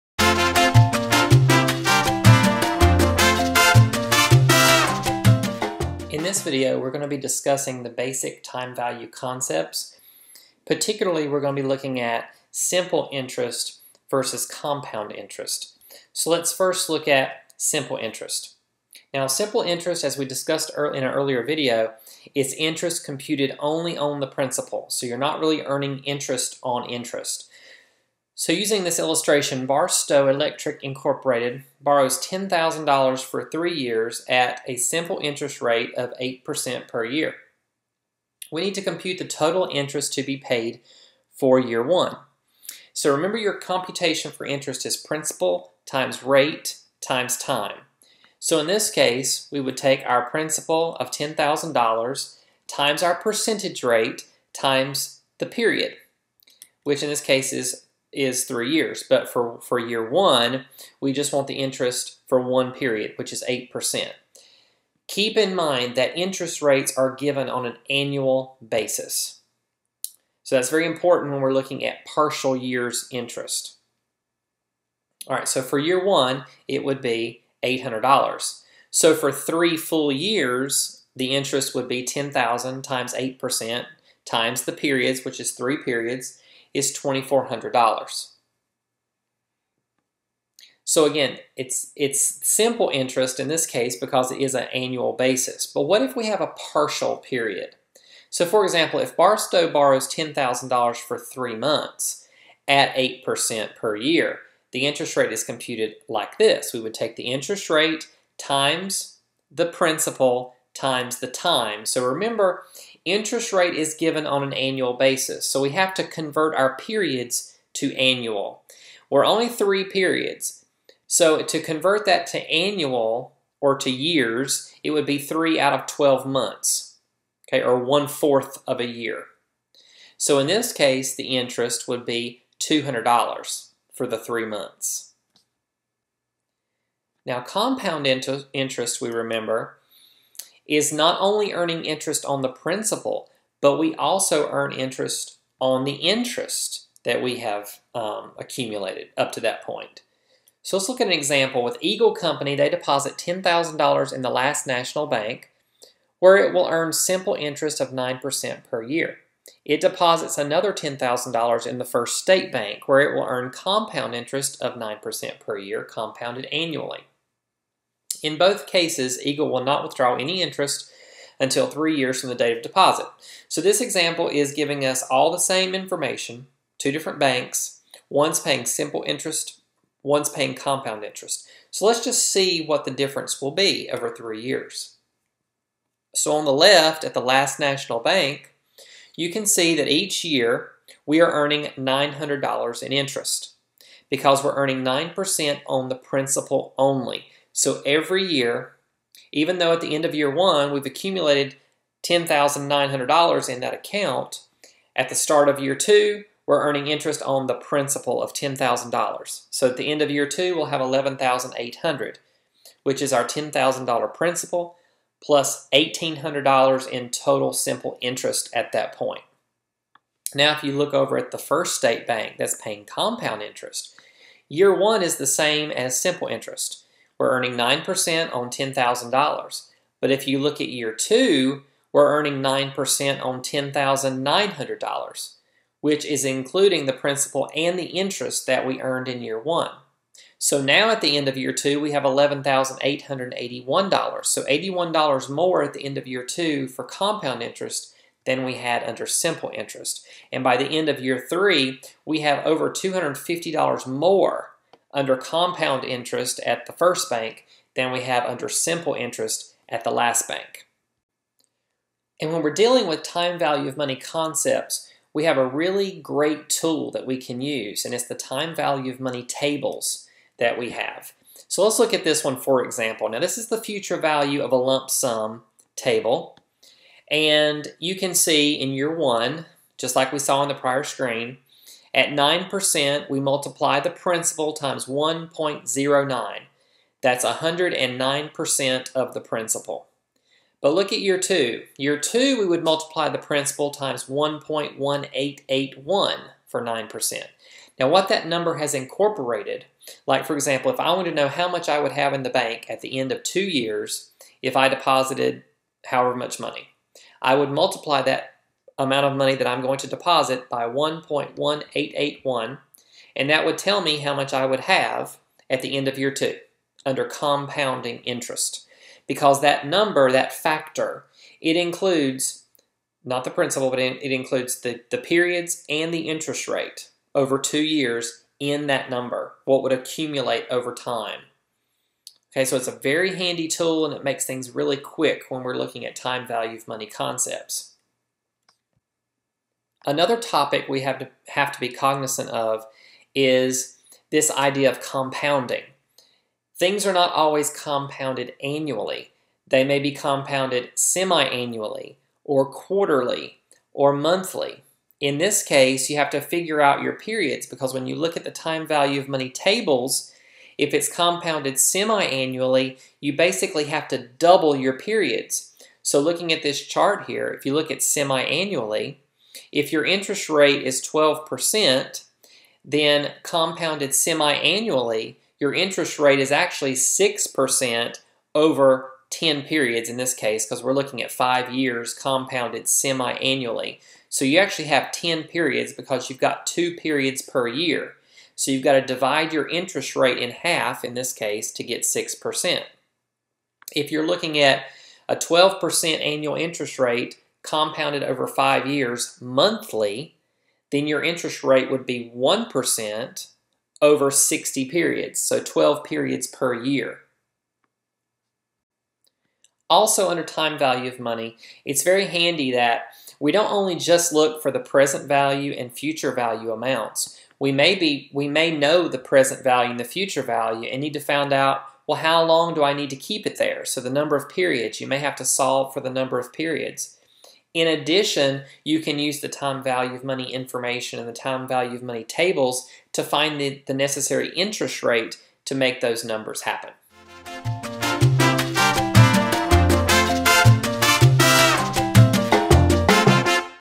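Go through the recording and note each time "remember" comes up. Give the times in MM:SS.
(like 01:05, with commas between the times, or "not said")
00:43, 01:52, 02:19.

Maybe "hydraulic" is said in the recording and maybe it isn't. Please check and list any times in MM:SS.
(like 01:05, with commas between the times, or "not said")
not said.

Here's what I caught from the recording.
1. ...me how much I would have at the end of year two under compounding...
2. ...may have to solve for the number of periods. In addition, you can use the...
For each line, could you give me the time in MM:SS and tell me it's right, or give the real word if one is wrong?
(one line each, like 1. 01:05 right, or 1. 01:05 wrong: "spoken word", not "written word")
1. 05:13 right
2. 07:04 right.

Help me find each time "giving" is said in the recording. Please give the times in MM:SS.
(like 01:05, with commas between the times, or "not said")
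02:54.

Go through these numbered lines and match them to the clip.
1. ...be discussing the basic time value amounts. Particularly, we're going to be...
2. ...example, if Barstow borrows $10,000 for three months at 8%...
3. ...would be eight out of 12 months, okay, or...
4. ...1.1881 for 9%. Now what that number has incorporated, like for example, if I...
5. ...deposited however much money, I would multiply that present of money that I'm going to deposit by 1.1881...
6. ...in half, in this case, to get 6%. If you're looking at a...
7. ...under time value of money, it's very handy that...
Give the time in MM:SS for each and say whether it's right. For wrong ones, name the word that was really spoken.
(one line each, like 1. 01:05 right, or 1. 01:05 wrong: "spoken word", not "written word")
1. 00:07 wrong: "concepts", not "amounts"
2. 01:38 right
3. 02:04 wrong: "three", not "eight"
4. 04:54 right
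5. 05:04 wrong: "amount", not "present"
6. 06:30 right
7. 06:50 right.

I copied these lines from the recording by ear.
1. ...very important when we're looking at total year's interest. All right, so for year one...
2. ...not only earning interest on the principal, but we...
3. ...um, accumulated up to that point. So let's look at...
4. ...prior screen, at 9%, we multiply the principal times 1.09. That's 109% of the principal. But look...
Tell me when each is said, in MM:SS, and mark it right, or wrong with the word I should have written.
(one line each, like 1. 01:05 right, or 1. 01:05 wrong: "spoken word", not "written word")
1. 01:10 wrong: "partial", not "total"
2. 02:20 right
3. 02:27 right
4. 04:40 right.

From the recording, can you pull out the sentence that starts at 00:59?
But for, for year one, we just want the interest for one period, which is 8%.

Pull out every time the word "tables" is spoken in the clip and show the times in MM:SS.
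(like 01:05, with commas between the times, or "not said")
04:29, 04:35, 05:59, 07:12.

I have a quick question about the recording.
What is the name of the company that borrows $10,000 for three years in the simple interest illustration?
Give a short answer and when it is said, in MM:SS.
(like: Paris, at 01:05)
Barstow Electric Incorporated, at 00:29.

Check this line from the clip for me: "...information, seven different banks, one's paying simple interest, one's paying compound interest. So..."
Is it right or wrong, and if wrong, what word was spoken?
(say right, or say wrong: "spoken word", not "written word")
wrong: "two", not "seven".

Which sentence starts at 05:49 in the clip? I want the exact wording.
They may be compounded semi-annually or quarterly or monthly.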